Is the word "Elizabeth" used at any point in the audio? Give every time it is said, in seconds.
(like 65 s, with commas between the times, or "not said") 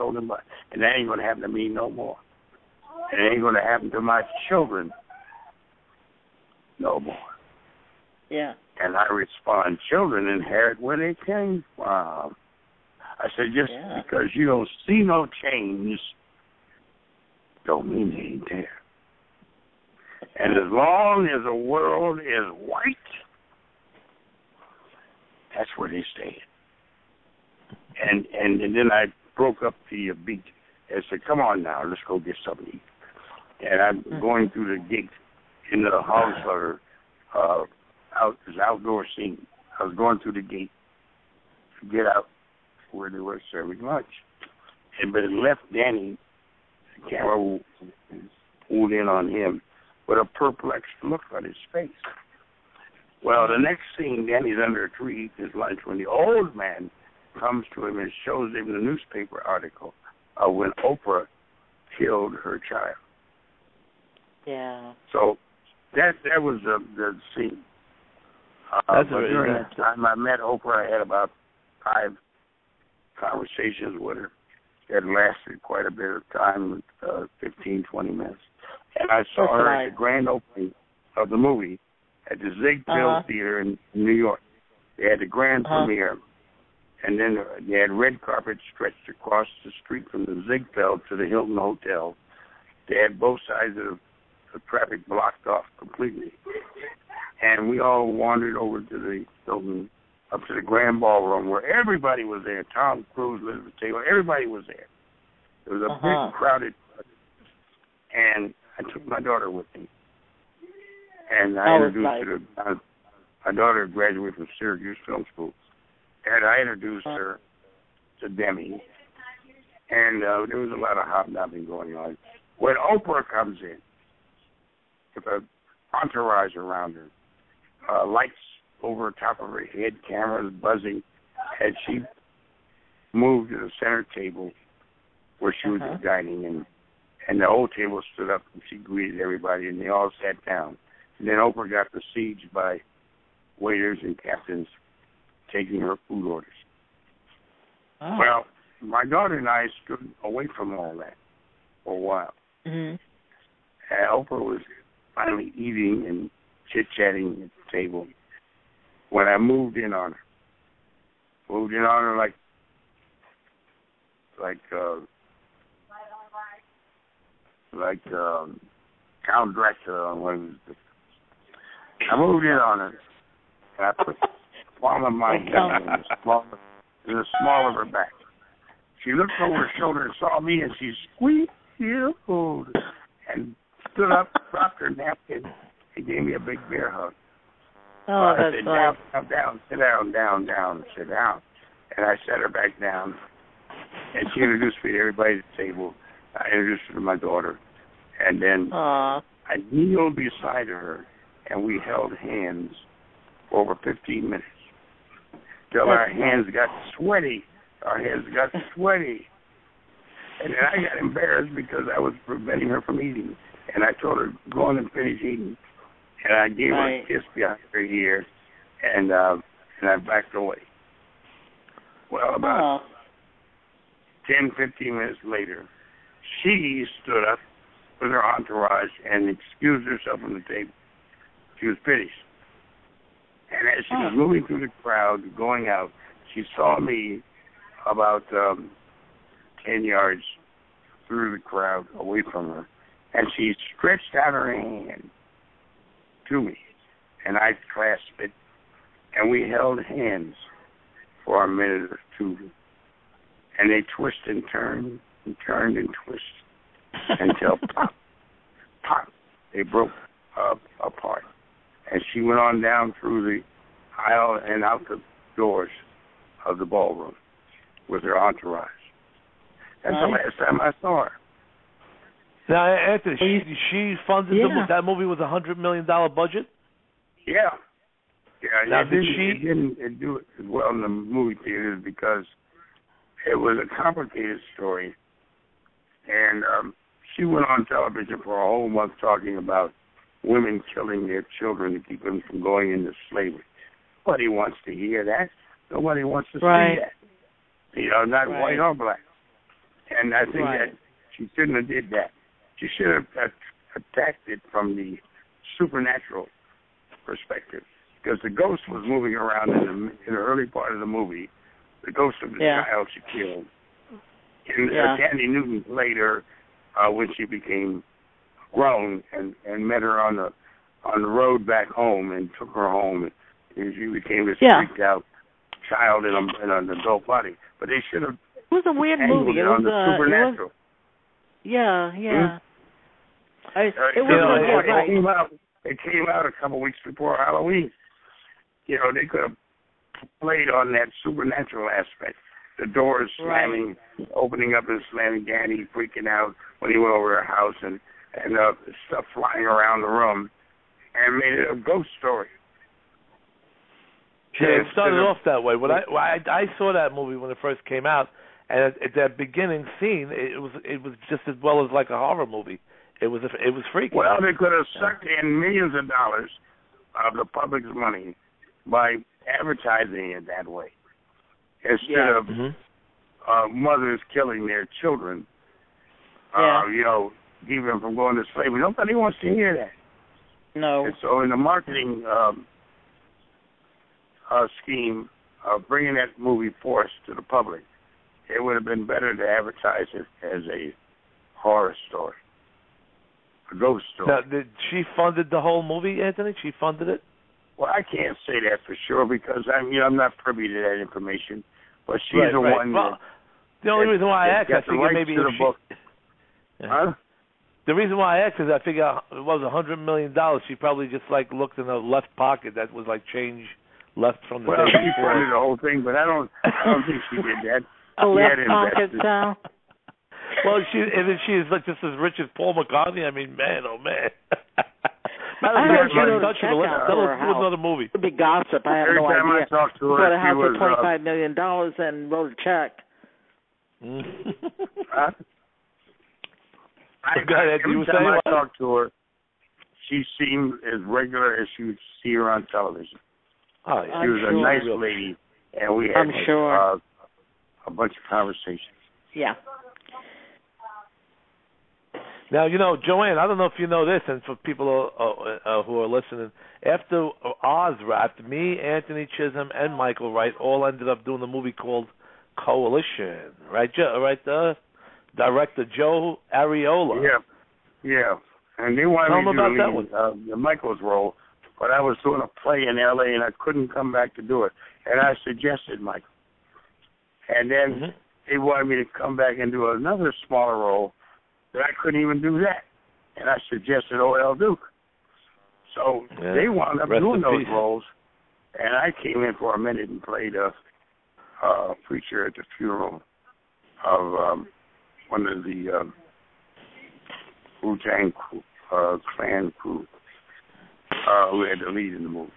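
103 s.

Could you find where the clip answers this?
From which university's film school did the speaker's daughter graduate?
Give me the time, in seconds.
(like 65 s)
114 s.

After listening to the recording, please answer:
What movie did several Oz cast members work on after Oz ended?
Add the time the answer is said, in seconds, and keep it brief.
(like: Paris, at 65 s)
Coalition, at 462 s.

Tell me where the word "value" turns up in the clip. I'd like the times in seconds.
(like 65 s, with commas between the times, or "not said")
not said.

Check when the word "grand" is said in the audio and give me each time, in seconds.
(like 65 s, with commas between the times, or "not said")
79 s, 85 s, 100 s.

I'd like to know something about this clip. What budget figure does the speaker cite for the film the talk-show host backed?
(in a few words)
$100 million.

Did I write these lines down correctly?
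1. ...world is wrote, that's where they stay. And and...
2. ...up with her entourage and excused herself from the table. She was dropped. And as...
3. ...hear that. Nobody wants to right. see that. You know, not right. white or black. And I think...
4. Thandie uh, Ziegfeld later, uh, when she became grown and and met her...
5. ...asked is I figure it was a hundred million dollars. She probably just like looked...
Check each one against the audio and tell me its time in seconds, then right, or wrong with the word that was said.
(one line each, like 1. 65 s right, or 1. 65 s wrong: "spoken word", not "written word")
1. 21 s wrong: "white", not "wrote"
2. 227 s wrong: "finished", not "dropped"
3. 294 s right
4. 314 s wrong: "Newton", not "Ziegfeld"
5. 408 s right.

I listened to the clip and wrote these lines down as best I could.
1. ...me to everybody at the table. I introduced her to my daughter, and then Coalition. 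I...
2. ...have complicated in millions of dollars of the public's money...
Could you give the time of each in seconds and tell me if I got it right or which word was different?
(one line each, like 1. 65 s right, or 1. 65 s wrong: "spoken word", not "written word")
1. 194 s wrong: "Aww", not "Coalition"
2. 364 s wrong: "sucked", not "complicated".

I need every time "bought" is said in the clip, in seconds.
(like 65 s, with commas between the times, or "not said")
0 s, 429 s.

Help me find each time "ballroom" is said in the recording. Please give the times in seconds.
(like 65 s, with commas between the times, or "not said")
101 s, 266 s.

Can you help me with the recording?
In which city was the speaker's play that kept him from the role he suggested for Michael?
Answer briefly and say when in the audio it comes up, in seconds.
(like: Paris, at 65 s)
L.A., at 472 s.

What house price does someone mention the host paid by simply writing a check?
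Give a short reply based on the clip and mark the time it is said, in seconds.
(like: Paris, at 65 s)
$25 million, at 430 s.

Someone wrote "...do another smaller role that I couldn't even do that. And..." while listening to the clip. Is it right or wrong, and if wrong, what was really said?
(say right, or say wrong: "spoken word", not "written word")
right.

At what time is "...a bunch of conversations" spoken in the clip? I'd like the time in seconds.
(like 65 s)
447 s.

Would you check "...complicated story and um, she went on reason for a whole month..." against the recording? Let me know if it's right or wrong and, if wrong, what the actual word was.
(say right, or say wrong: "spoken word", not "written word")
wrong: "television", not "reason".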